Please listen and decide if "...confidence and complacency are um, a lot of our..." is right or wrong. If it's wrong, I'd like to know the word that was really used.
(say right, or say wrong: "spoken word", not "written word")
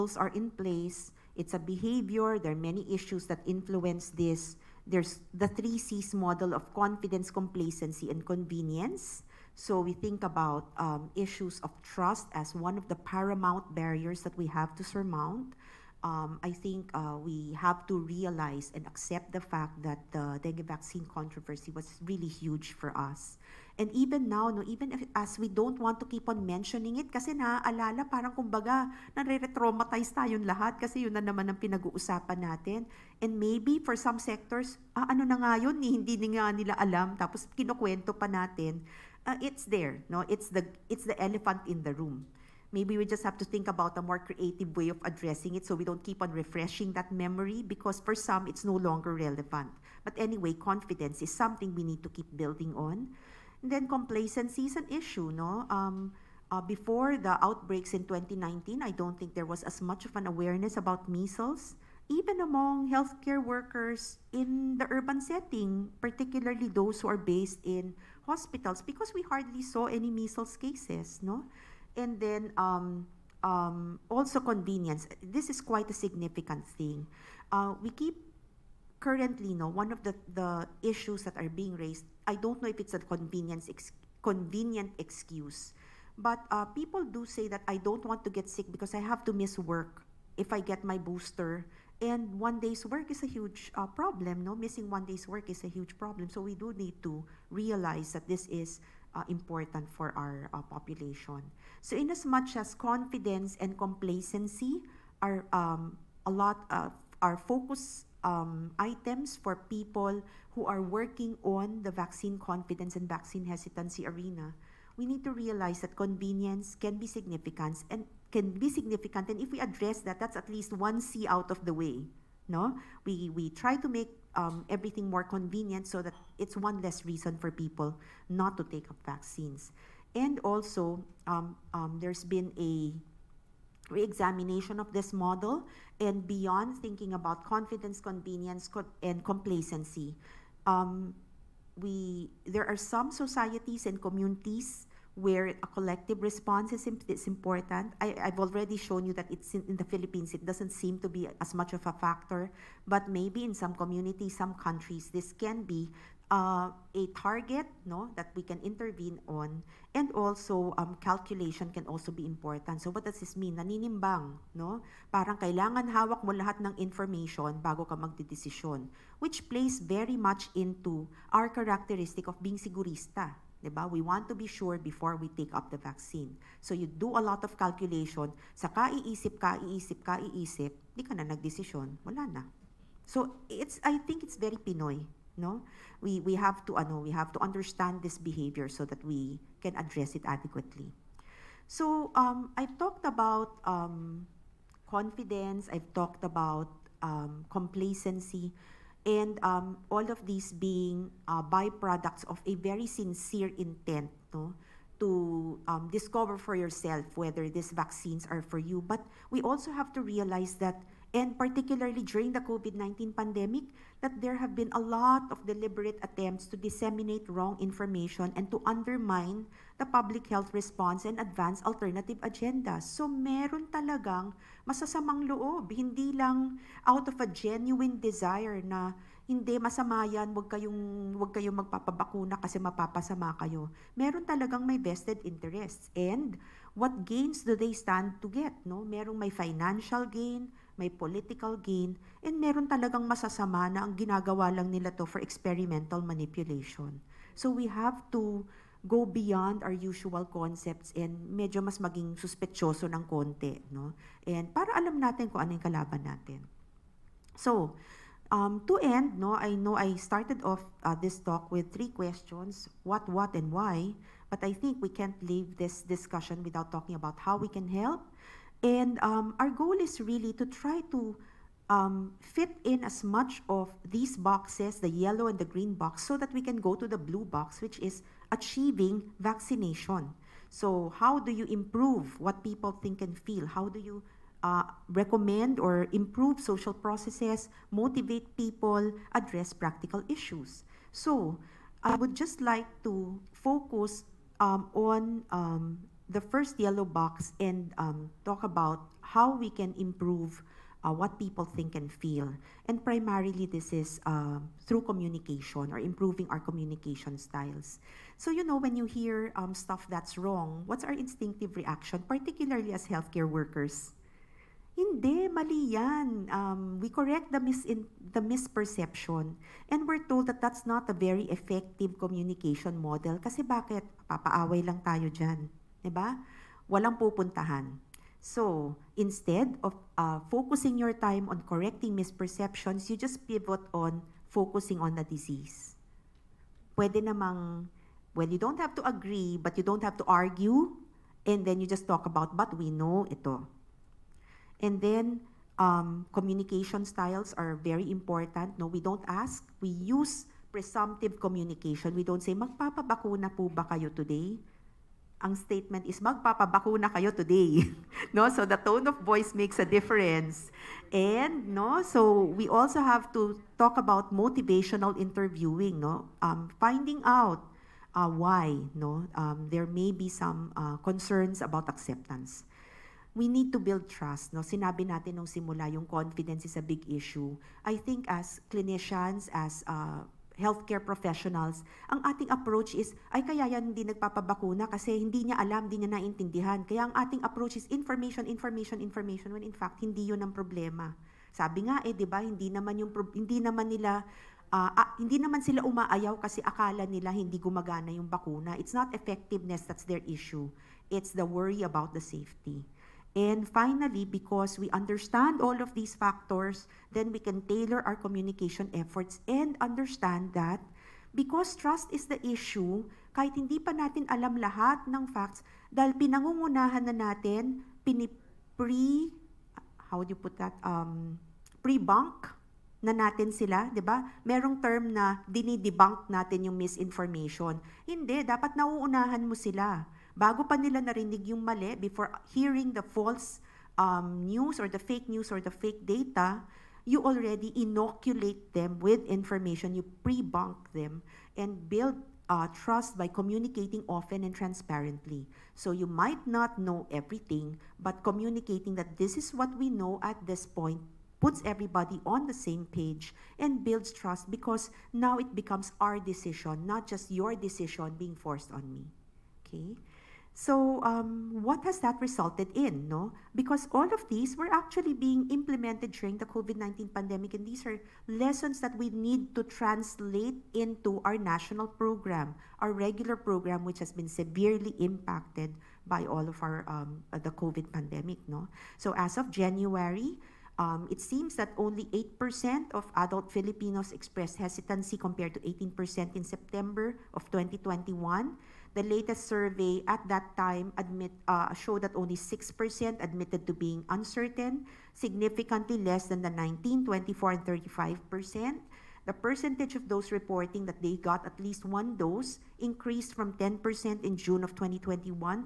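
right.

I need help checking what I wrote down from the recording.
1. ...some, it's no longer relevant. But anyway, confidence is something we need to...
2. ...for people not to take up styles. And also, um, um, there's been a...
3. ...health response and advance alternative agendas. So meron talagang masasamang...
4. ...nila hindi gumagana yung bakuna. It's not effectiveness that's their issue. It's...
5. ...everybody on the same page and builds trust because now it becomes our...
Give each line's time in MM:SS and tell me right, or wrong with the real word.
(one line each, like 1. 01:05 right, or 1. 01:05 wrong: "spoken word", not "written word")
1. 00:48 right
2. 02:07 wrong: "vaccines", not "styles"
3. 03:40 right
4. 06:36 right
5. 07:31 right.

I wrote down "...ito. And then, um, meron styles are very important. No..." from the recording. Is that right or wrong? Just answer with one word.
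wrong.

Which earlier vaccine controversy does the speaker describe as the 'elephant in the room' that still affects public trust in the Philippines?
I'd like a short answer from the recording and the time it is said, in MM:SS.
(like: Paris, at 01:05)
dengue vaccine, at 00:20.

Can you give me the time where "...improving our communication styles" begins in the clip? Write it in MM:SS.
05:05.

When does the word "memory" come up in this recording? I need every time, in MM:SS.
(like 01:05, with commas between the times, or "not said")
00:47.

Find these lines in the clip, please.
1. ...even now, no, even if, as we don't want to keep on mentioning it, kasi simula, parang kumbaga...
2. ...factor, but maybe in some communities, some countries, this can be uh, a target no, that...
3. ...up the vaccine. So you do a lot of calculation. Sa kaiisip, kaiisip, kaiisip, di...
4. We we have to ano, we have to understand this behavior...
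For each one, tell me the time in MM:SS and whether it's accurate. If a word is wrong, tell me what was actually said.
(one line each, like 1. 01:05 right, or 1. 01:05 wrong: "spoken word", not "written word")
1. 00:23 wrong: "naaalala", not "simula"
2. 02:31 right
3. 02:55 right
4. 03:06 right.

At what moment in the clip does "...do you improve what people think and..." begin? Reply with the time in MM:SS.
04:41.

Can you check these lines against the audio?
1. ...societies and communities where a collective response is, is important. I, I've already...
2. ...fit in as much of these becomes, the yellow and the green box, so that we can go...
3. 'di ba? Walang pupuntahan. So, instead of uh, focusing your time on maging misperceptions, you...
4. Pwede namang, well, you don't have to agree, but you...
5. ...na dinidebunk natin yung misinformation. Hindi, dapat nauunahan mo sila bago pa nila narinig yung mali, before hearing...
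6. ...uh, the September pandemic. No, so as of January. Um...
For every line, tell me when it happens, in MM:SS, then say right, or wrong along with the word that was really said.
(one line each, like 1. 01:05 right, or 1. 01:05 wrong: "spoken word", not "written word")
1. 02:23 right
2. 04:32 wrong: "boxes", not "becomes"
3. 05:25 wrong: "correcting", not "maging"
4. 05:36 right
5. 07:04 right
6. 07:57 wrong: "COVID", not "September".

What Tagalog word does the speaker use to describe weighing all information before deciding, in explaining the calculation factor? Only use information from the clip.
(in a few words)
Naninimbang.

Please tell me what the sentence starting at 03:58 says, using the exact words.
Merong may financial gain, may political gain, and meron talagang masasama na ang ginagawa lang nila to for experimental manipulation.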